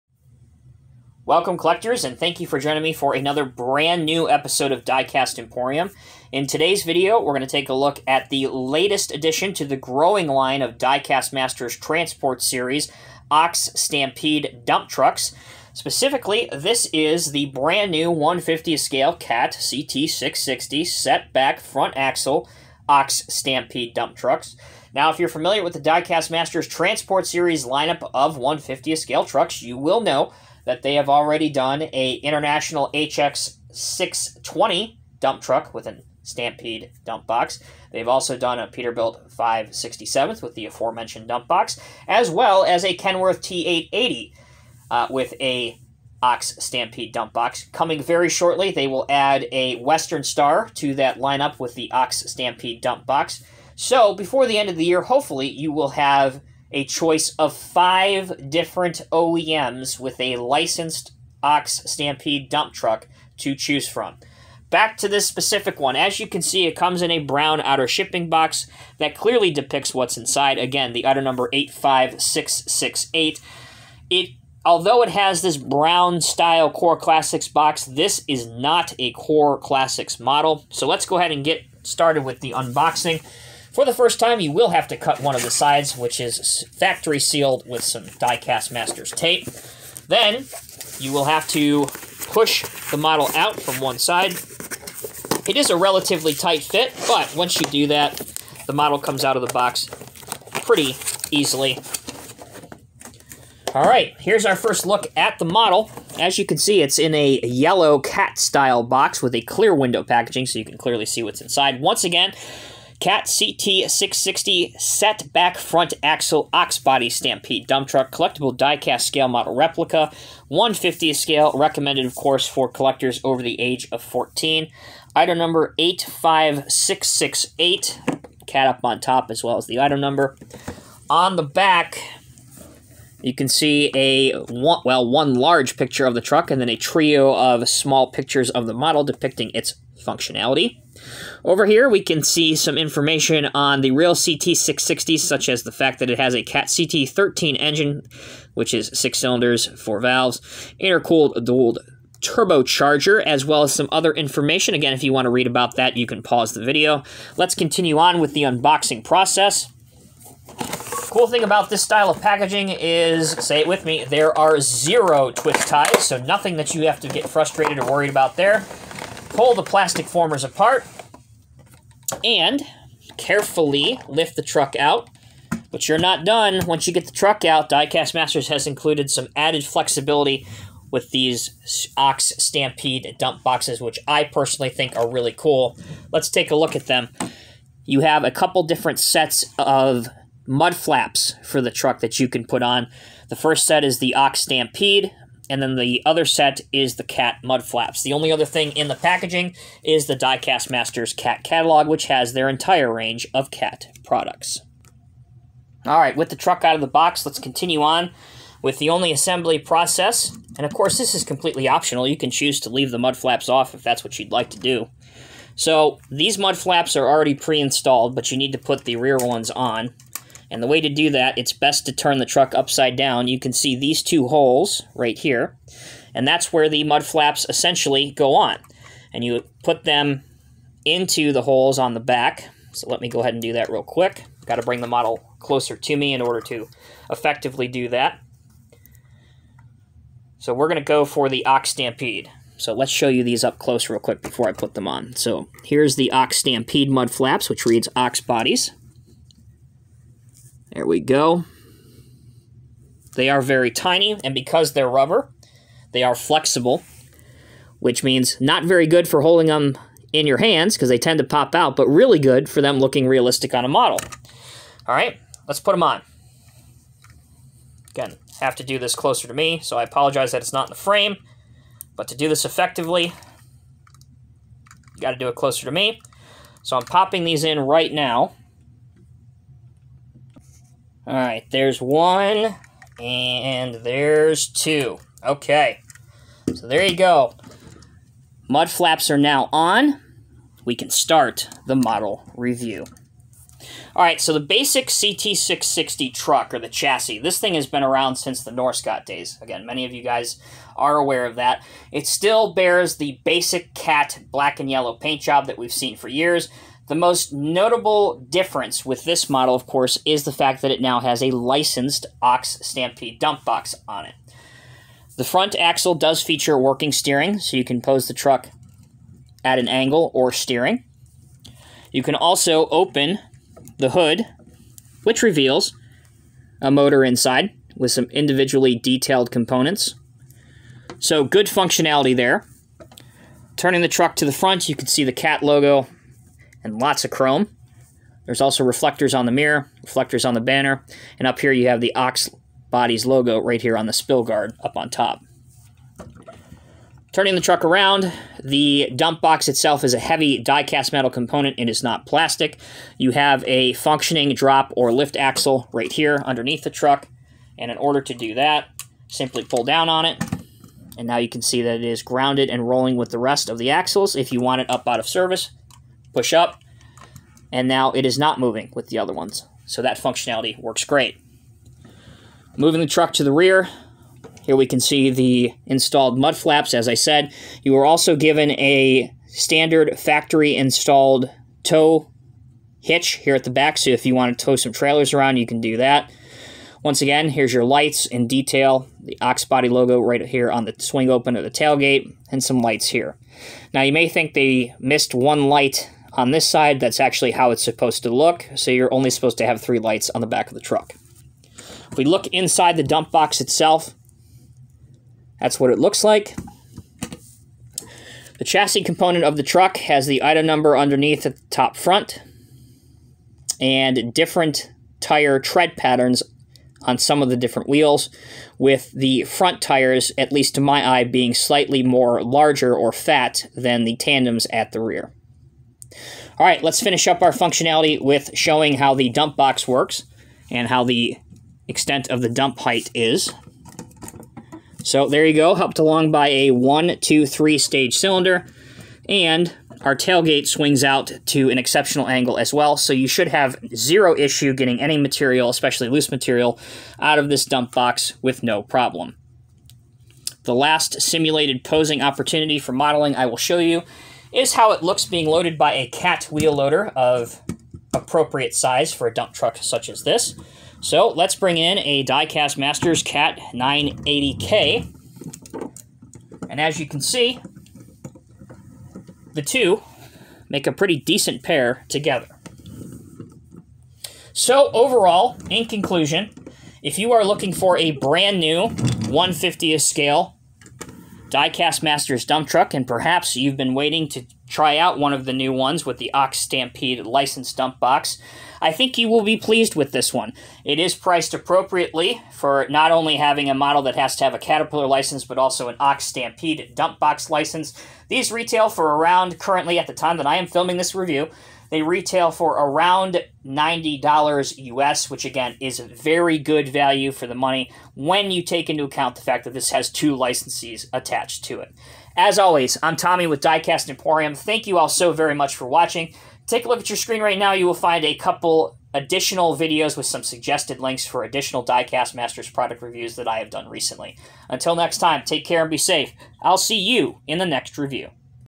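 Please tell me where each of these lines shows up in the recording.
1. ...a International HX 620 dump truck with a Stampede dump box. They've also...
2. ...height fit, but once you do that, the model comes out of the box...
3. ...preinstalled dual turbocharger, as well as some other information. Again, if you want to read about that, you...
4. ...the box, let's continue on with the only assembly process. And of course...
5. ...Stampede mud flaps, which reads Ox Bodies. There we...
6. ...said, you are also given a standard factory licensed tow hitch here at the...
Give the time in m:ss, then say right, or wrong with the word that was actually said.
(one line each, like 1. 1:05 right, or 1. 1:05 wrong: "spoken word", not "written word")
1. 0:31 right
2. 1:36 wrong: "tight", not "height"
3. 2:30 wrong: "intercooled", not "preinstalled"
4. 3:26 right
5. 4:06 right
6. 6:16 wrong: "installed", not "licensed".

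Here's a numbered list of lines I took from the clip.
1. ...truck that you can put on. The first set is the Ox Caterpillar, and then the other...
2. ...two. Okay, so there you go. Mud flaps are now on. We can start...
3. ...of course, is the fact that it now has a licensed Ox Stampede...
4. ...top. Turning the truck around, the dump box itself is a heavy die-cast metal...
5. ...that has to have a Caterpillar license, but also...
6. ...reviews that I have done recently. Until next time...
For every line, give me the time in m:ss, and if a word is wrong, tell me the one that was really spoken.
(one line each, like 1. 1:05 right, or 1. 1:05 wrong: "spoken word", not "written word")
1. 3:11 wrong: "Stampede", not "Caterpillar"
2. 4:44 right
3. 5:09 right
4. 5:44 right
5. 8:13 right
6. 8:42 right.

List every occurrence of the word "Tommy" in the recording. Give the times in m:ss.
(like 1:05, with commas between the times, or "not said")
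8:32.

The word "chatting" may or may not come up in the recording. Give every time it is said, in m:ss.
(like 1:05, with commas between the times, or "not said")
not said.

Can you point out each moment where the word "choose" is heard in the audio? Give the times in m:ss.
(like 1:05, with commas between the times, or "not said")
1:03, 3:32.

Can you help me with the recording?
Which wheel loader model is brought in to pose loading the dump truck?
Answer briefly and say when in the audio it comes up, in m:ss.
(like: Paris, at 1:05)
Cat 980K, at 7:43.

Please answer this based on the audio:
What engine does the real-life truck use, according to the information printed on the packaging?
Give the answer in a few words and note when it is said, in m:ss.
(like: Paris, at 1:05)
CAT CT13, at 2:26.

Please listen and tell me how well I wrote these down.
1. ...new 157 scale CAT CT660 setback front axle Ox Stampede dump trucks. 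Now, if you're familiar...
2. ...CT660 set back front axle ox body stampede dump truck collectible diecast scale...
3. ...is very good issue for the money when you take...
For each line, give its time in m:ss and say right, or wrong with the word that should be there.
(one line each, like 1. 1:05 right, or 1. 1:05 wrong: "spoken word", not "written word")
1. 0:17 wrong: "150", not "157"
2. 1:53 right
3. 8:25 wrong: "value", not "issue".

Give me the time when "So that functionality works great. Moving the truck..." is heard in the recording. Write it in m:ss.
6:09.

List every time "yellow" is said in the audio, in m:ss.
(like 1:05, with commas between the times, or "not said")
1:47, 5:04.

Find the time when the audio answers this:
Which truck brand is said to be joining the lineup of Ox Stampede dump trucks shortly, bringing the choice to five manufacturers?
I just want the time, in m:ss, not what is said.
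0:49.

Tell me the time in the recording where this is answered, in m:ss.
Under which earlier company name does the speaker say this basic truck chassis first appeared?
4:58.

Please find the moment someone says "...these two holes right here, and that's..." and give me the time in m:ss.
3:43.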